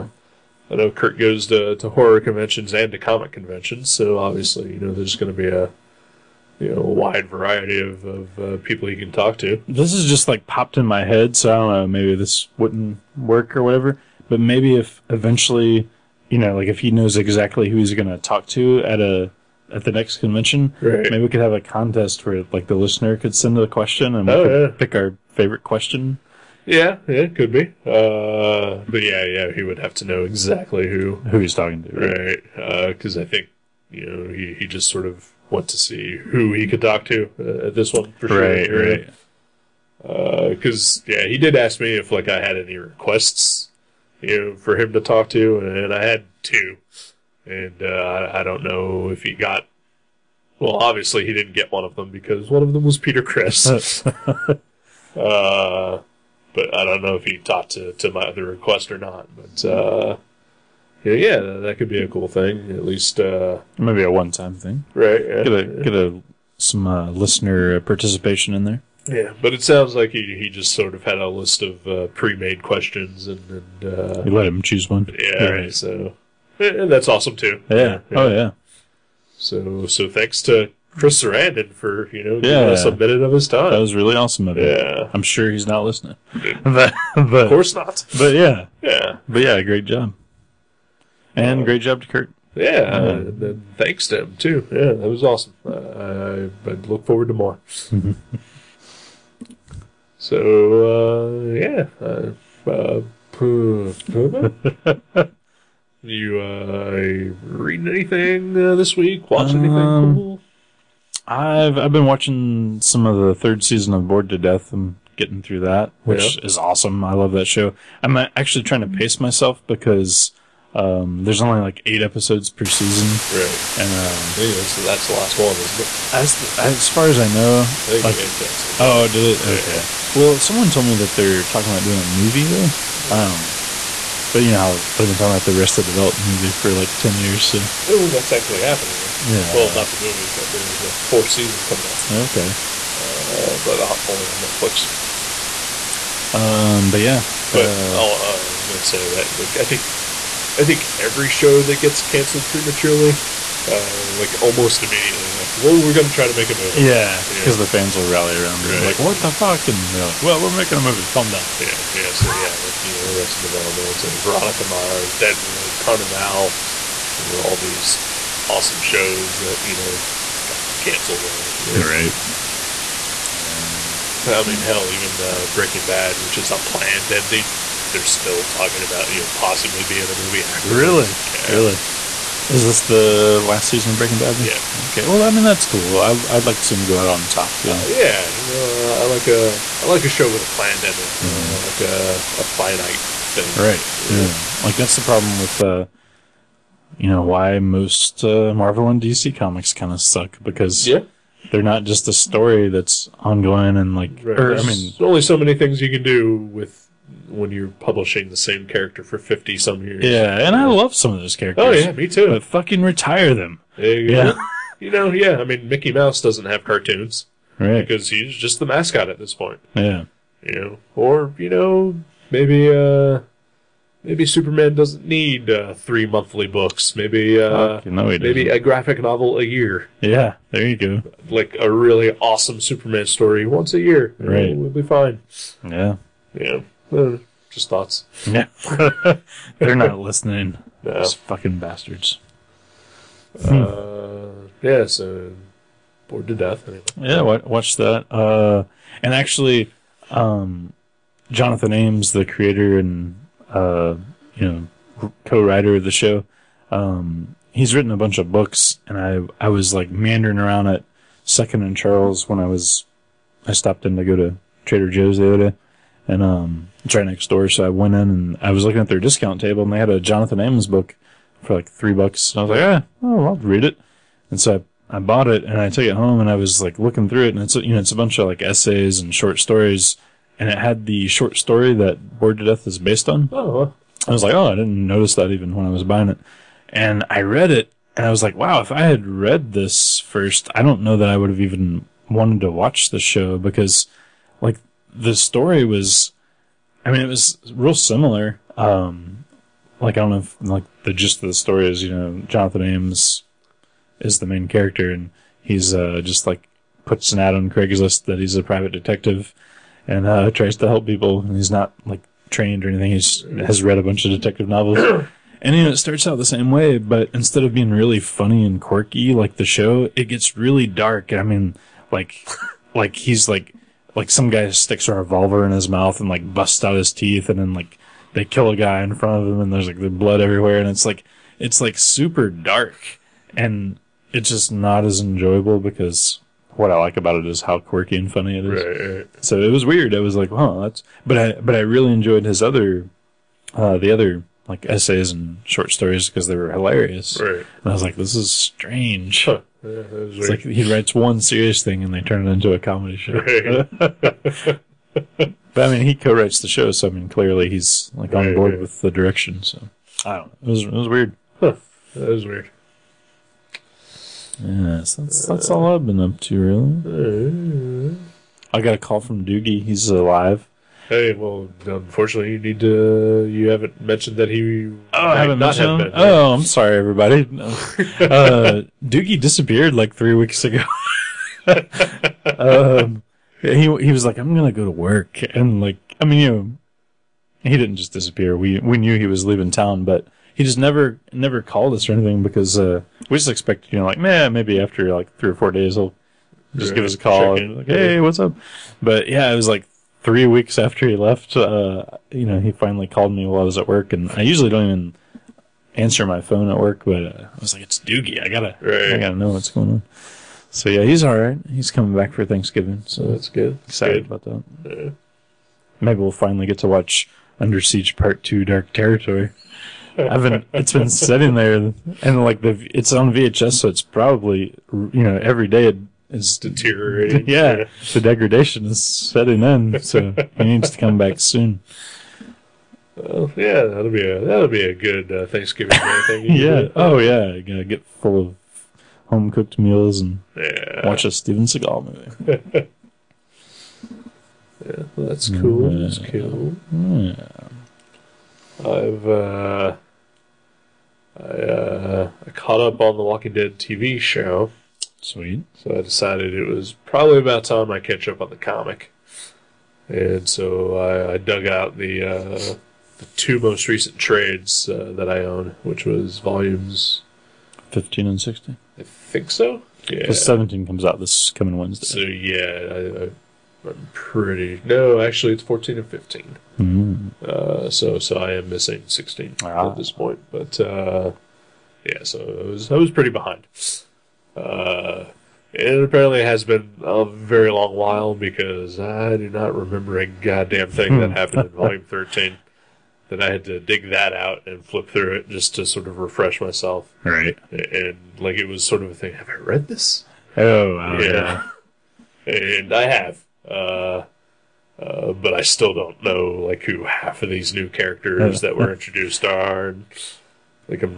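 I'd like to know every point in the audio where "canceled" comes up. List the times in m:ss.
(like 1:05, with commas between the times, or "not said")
2:08, 2:32, 2:50.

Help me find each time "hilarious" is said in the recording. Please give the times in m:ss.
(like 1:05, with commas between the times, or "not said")
5:46.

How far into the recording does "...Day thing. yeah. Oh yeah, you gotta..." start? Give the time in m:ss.
7:15.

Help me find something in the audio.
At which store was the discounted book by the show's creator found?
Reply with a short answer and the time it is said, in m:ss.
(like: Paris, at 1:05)
Second and Charles, at 4:21.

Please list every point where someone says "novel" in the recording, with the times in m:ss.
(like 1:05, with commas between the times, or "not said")
3:49, 5:14.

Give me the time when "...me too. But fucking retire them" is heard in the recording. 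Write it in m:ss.
3:31.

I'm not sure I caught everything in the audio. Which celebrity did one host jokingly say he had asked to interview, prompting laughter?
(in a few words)
Peter Criss.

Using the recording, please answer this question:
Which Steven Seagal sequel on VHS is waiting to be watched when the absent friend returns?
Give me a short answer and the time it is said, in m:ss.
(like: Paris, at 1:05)
Under Siege Part Two: Dark Territory, at 6:57.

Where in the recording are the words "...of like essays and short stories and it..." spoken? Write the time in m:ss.
4:38.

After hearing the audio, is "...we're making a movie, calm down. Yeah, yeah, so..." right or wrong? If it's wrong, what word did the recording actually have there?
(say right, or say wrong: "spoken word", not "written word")
right.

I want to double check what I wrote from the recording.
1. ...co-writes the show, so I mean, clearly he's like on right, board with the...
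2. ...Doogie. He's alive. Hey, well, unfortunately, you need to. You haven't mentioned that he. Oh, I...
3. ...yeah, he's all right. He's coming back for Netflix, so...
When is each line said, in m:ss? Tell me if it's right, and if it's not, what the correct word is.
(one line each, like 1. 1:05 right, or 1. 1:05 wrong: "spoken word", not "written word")
1. 5:55 right
2. 6:09 right
3. 6:50 wrong: "Thanksgiving", not "Netflix".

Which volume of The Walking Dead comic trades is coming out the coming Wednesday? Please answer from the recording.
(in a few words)
17.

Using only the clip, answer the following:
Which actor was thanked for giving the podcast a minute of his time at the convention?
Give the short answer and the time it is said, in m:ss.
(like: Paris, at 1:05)
Chris Sarandon, at 1:20.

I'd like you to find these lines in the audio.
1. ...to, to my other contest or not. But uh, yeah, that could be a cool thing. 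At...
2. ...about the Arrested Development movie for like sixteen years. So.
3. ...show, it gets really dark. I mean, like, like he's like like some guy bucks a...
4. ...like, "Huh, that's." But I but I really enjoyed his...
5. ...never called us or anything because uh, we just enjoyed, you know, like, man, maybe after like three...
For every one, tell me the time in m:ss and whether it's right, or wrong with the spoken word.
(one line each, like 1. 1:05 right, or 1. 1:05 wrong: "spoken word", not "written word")
1. 0:57 wrong: "request", not "contest"
2. 2:15 wrong: "ten", not "sixteen"
3. 5:19 wrong: "sticks", not "bucks"
4. 5:40 right
5. 6:31 wrong: "expected", not "enjoyed".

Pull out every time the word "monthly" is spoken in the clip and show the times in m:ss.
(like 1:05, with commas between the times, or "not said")
3:46.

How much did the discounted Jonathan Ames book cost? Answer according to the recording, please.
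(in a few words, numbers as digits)
3 dollars.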